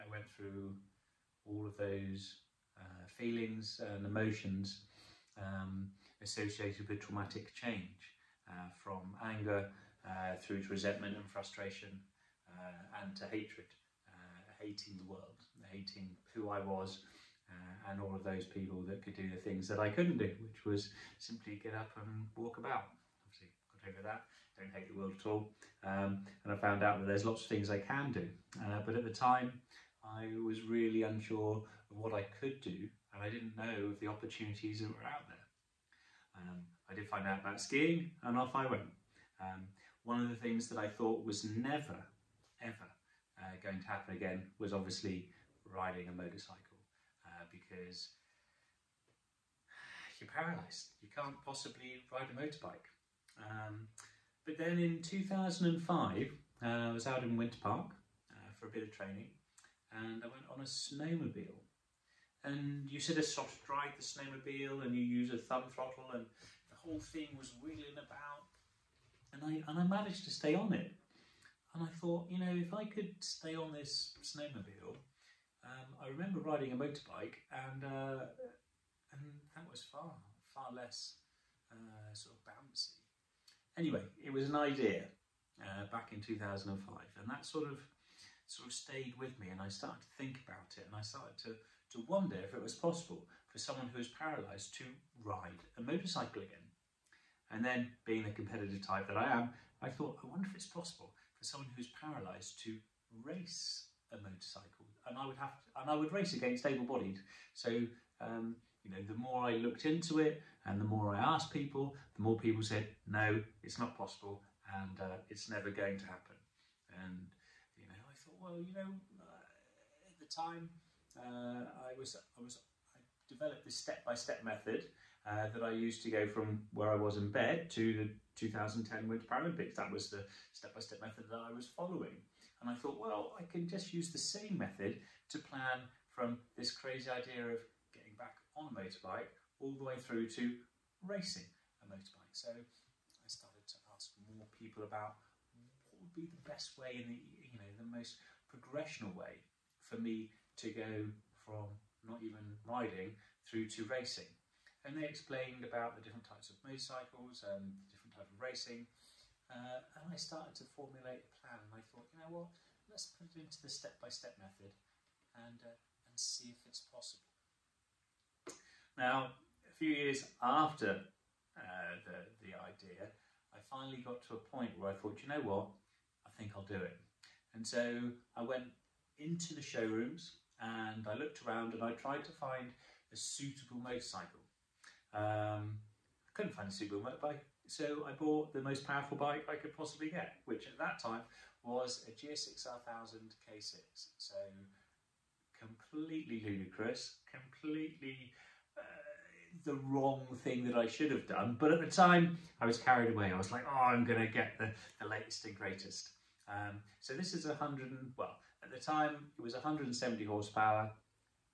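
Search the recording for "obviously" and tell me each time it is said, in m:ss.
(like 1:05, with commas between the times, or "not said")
0:23, 0:44.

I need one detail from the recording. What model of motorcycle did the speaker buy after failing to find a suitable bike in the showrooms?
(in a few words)
GSX R1000 K6.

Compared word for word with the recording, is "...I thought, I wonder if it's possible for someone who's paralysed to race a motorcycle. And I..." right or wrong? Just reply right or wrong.
right.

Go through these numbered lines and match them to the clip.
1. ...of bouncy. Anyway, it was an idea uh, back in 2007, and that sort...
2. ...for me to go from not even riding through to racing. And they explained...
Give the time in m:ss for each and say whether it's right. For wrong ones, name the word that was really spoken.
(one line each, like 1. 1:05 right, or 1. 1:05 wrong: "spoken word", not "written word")
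1. 1:22 wrong: "2005", not "2007"
2. 2:29 right.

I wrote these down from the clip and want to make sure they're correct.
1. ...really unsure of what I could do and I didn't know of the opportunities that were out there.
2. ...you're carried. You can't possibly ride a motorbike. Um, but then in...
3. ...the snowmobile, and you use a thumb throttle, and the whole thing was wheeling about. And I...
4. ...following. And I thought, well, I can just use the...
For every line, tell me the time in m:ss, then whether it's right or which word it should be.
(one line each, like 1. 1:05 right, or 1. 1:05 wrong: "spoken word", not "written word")
1. 0:30 right
2. 0:50 wrong: "paralysed", not "carried"
3. 1:03 right
4. 2:11 right.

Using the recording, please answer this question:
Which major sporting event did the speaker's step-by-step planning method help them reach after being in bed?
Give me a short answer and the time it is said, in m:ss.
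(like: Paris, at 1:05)
2010 Winter Paralympics, at 2:08.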